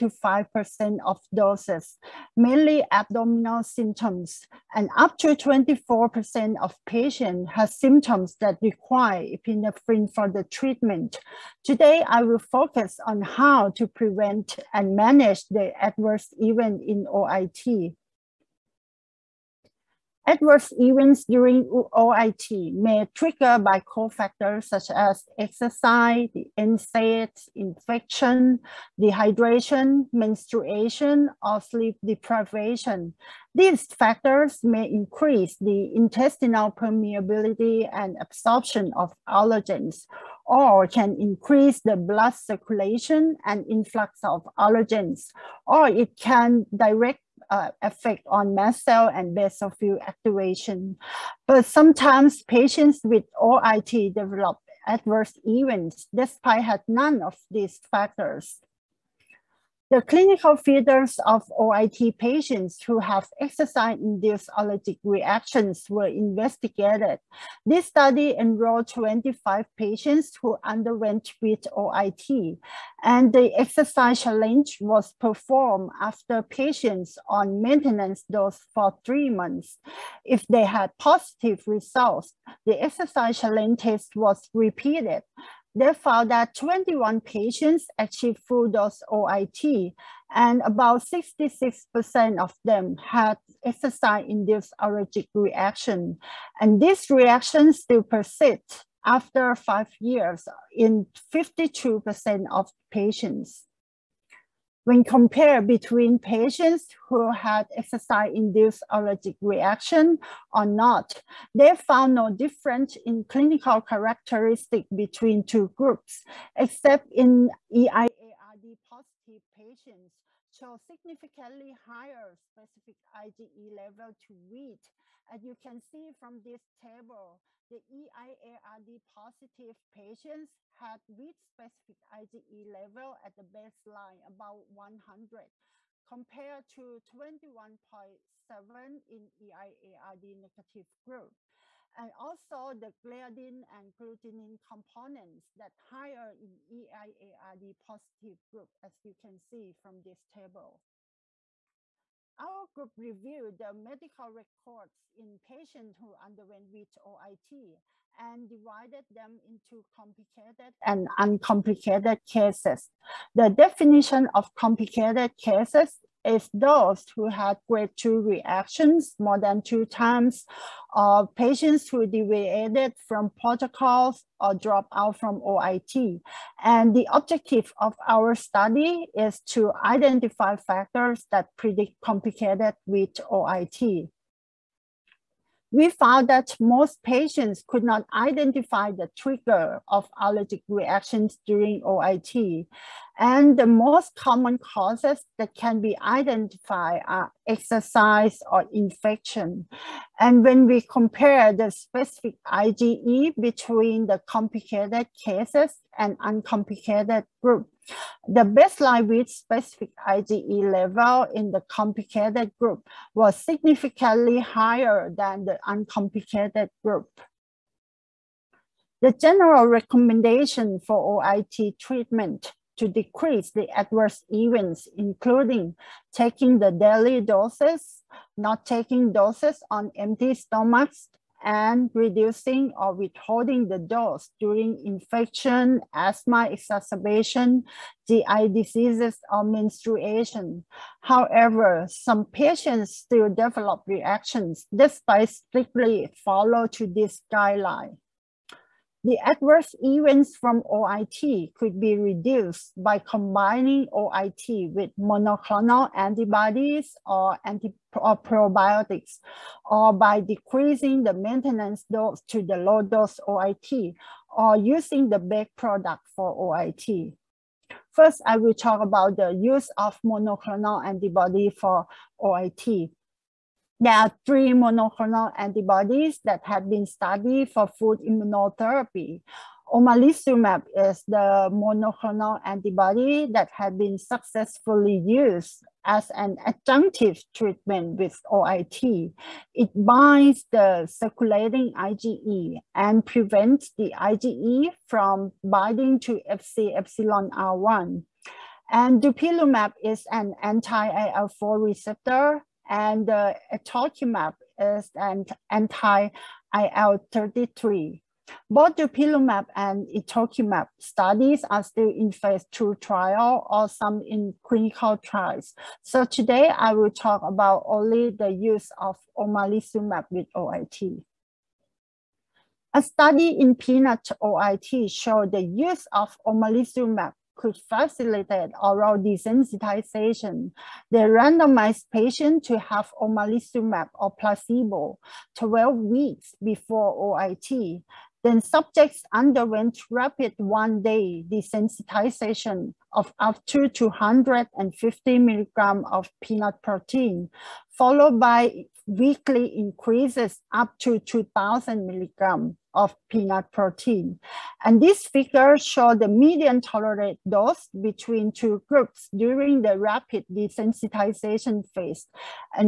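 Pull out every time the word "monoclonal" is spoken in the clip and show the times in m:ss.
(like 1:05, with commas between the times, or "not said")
4:14, 4:30, 4:34, 4:41.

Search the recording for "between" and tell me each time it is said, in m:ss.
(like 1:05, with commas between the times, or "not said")
1:45, 1:54, 3:23, 5:57.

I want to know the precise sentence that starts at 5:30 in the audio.
They randomized patients to have omalizumab or placebo 12 weeks before OIT.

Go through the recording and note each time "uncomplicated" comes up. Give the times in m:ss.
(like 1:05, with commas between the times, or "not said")
2:41, 3:26, 3:35.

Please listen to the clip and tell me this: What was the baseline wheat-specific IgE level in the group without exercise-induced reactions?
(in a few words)
21.7.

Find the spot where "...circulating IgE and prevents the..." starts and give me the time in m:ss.
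4:50.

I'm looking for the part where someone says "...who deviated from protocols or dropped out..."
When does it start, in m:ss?
2:51.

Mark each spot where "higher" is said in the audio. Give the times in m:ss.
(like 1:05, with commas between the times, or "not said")
2:01, 2:25, 3:34.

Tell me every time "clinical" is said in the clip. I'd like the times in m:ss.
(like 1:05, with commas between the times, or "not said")
1:00, 1:53, 5:14.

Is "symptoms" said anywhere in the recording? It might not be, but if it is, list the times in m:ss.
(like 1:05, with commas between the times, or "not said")
0:03, 0:07.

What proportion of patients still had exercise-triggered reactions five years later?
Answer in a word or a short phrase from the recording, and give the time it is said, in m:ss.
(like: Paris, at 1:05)
52%, at 1:41.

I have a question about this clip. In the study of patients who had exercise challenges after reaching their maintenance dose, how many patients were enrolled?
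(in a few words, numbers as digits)
25.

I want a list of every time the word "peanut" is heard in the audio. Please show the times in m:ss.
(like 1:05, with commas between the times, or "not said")
5:23, 5:46, 5:53.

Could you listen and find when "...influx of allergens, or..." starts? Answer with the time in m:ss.
0:43.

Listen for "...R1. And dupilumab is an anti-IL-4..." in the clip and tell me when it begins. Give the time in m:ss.
4:57.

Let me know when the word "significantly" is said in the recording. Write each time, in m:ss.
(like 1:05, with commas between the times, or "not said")
2:00, 3:33.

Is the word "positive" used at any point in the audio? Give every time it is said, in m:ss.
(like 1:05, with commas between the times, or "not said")
1:20, 1:58, 2:09, 2:27.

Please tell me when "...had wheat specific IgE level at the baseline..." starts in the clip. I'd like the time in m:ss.
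2:10.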